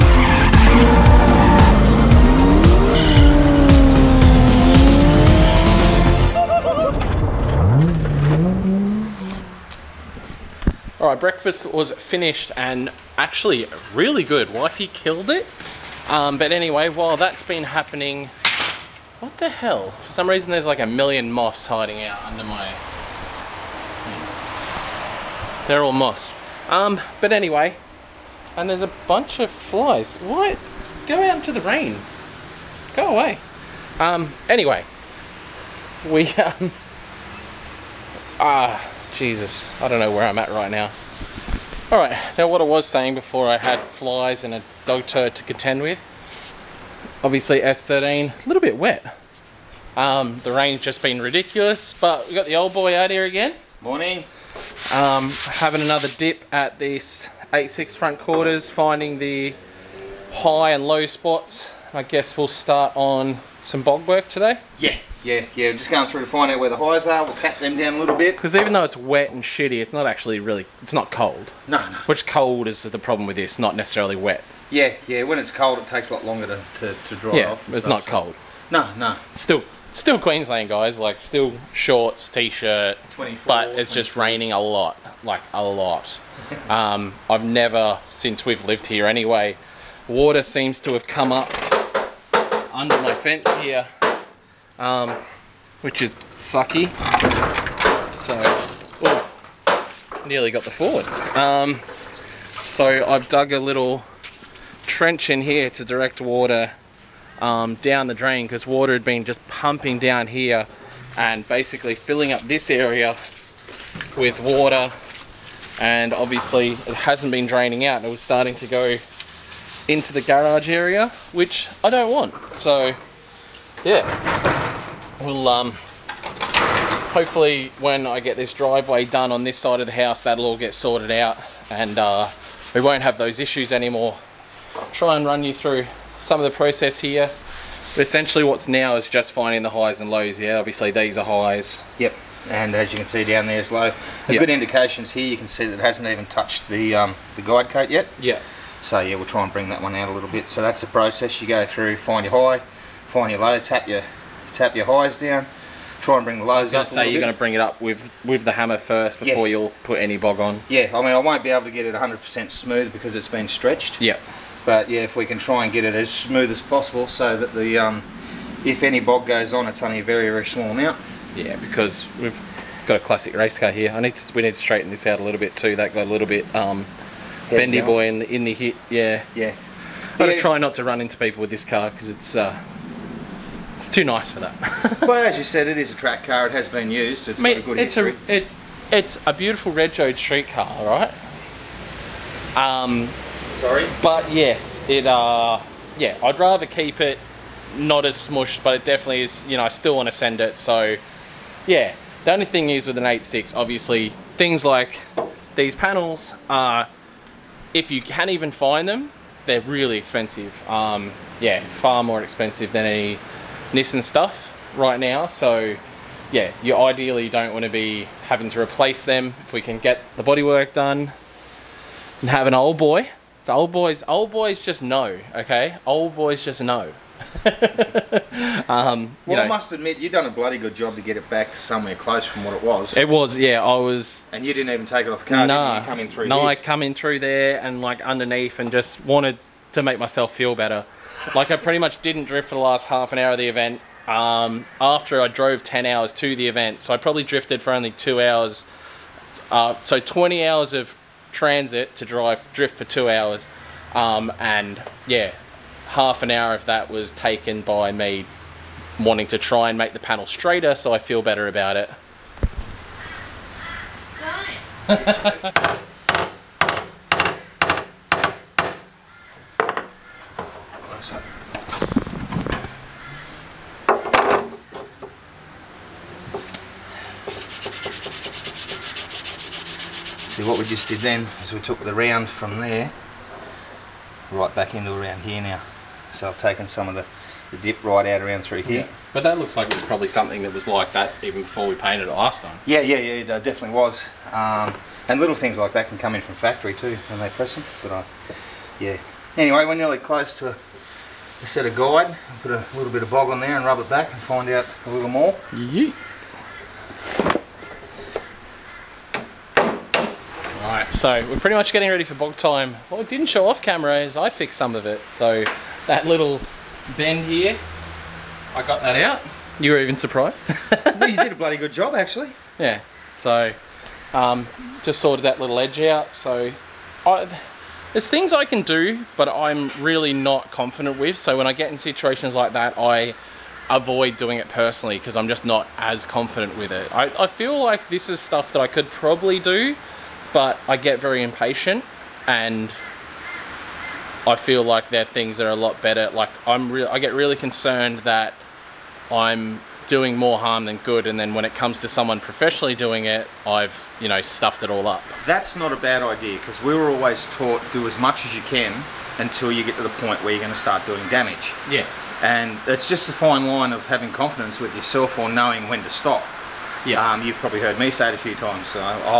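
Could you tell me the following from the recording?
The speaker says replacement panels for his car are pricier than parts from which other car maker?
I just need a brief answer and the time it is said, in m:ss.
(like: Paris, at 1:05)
Nissan, at 3:33.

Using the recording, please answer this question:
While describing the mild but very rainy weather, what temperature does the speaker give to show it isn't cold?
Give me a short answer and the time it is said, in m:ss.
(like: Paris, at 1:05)
24, at 1:23.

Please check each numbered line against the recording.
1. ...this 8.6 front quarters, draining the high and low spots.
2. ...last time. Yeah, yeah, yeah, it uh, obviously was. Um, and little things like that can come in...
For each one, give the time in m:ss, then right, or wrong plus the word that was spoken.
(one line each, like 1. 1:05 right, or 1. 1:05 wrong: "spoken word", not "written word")
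1. 0:56 wrong: "finding", not "draining"
2. 4:52 wrong: "definitely", not "obviously".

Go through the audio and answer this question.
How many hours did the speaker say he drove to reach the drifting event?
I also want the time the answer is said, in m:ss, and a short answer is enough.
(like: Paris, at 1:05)
10 hours, at 4:05.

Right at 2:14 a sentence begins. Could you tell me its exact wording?
Try and run you through some of the process here.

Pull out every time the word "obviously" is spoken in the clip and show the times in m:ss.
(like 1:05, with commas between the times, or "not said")
0:47, 1:56, 2:20, 3:23.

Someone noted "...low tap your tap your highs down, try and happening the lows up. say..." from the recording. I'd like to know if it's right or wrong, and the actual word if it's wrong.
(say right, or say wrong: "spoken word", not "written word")
wrong: "bring", not "happening".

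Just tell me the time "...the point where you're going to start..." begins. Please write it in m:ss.
5:59.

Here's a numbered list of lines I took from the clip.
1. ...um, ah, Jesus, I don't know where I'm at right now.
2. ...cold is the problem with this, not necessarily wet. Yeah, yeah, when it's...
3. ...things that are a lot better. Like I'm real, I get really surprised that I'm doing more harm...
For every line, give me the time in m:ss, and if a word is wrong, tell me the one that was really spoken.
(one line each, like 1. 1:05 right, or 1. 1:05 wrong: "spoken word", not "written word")
1. 0:36 right
2. 1:12 right
3. 5:45 wrong: "concerned", not "surprised".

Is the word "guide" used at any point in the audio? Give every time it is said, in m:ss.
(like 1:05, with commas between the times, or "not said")
2:27, 5:01.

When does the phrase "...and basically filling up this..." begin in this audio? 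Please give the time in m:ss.
1:51.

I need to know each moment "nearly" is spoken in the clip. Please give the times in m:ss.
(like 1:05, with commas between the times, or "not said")
1:40, 4:59.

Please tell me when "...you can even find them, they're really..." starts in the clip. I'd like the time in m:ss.
3:27.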